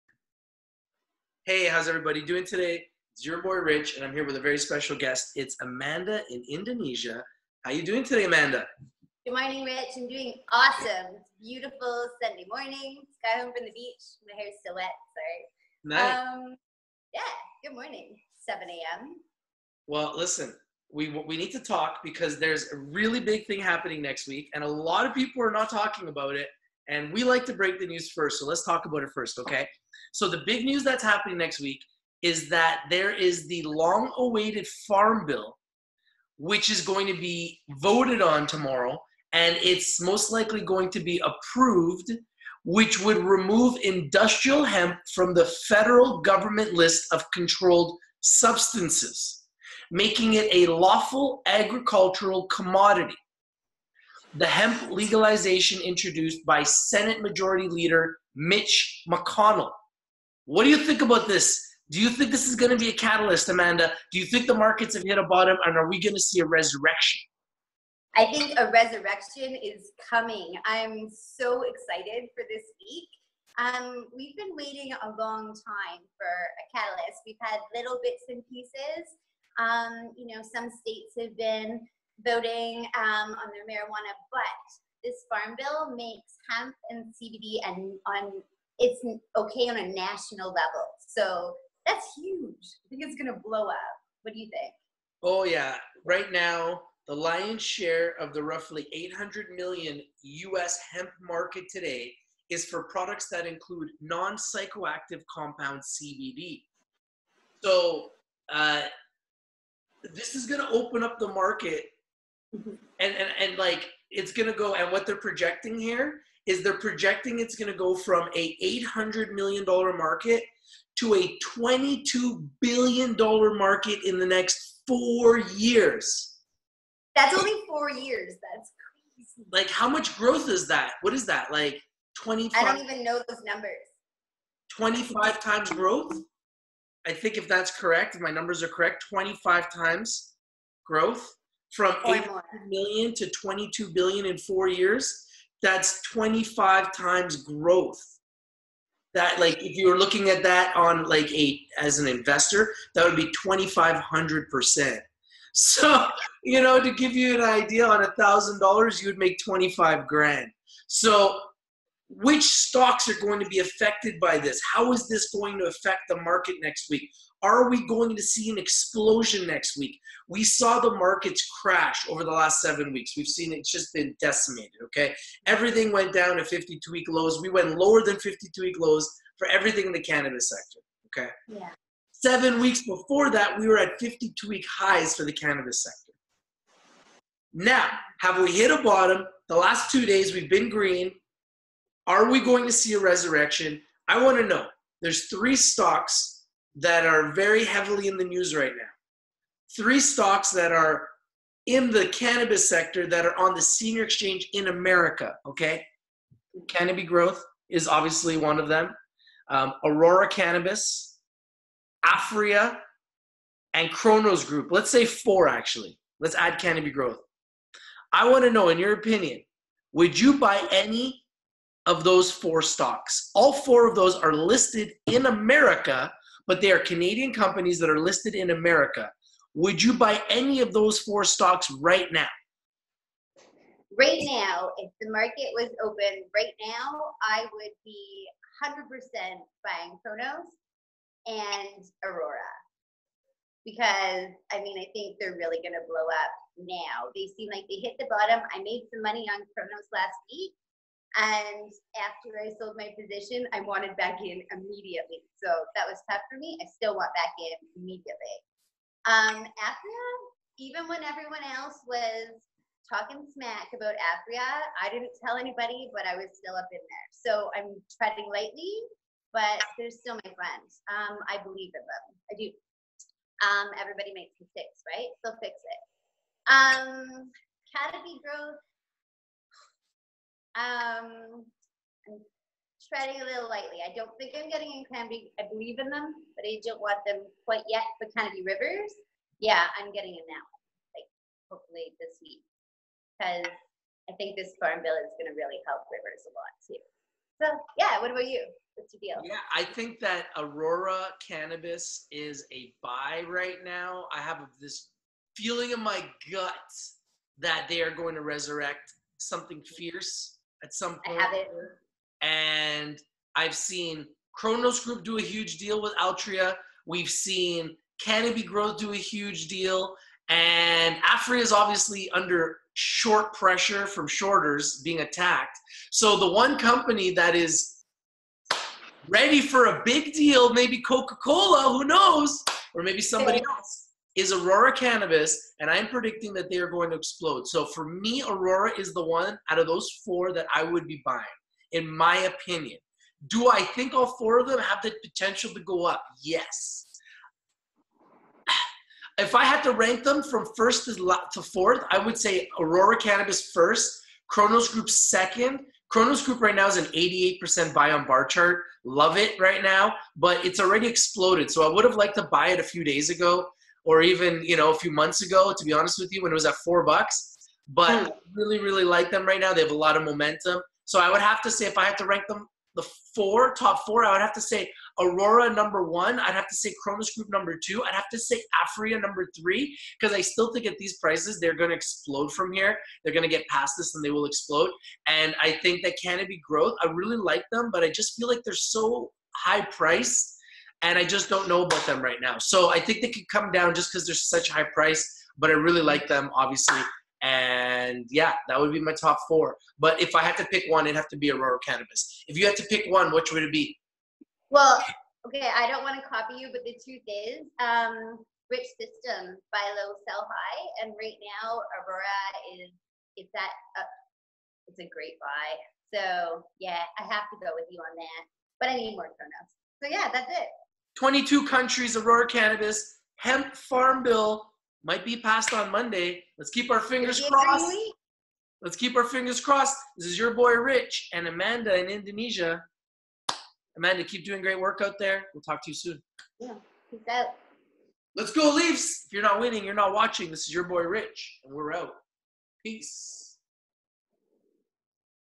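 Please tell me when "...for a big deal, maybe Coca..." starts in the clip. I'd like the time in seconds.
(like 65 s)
329 s.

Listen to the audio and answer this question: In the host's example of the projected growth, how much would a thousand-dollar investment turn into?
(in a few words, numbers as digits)
25 grand.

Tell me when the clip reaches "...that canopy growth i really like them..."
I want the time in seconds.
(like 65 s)
385 s.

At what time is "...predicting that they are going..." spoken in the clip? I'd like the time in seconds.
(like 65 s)
335 s.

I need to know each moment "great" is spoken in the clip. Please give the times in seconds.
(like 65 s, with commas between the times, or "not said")
414 s, 434 s.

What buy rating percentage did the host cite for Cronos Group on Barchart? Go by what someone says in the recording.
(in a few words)
88%.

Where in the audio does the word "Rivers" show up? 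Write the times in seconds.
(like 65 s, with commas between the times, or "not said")
288 s, 295 s.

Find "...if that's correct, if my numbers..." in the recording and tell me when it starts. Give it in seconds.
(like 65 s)
137 s.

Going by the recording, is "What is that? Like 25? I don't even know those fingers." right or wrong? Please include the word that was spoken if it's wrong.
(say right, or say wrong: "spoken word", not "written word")
wrong: "numbers", not "fingers".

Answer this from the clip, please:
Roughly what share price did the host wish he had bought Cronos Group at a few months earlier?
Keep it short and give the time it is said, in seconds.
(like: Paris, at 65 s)
4 dollars, at 366 s.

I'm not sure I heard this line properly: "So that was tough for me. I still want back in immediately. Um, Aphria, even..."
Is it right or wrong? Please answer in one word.
right.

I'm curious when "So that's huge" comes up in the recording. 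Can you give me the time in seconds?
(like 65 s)
91 s.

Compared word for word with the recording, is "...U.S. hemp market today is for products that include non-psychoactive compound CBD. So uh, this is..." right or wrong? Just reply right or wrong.
right.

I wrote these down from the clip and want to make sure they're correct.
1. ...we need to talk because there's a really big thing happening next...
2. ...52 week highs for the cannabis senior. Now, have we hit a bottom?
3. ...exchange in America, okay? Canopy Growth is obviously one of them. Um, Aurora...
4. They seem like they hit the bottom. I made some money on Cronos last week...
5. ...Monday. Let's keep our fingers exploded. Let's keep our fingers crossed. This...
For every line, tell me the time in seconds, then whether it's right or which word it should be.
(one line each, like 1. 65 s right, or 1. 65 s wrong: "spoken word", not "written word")
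1. 21 s right
2. 183 s wrong: "sector", not "senior"
3. 204 s right
4. 247 s right
5. 425 s wrong: "crossed", not "exploded".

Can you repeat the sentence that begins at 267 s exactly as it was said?
So I'm treading lightly, but they're still my friends.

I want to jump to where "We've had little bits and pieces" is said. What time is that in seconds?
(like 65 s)
77 s.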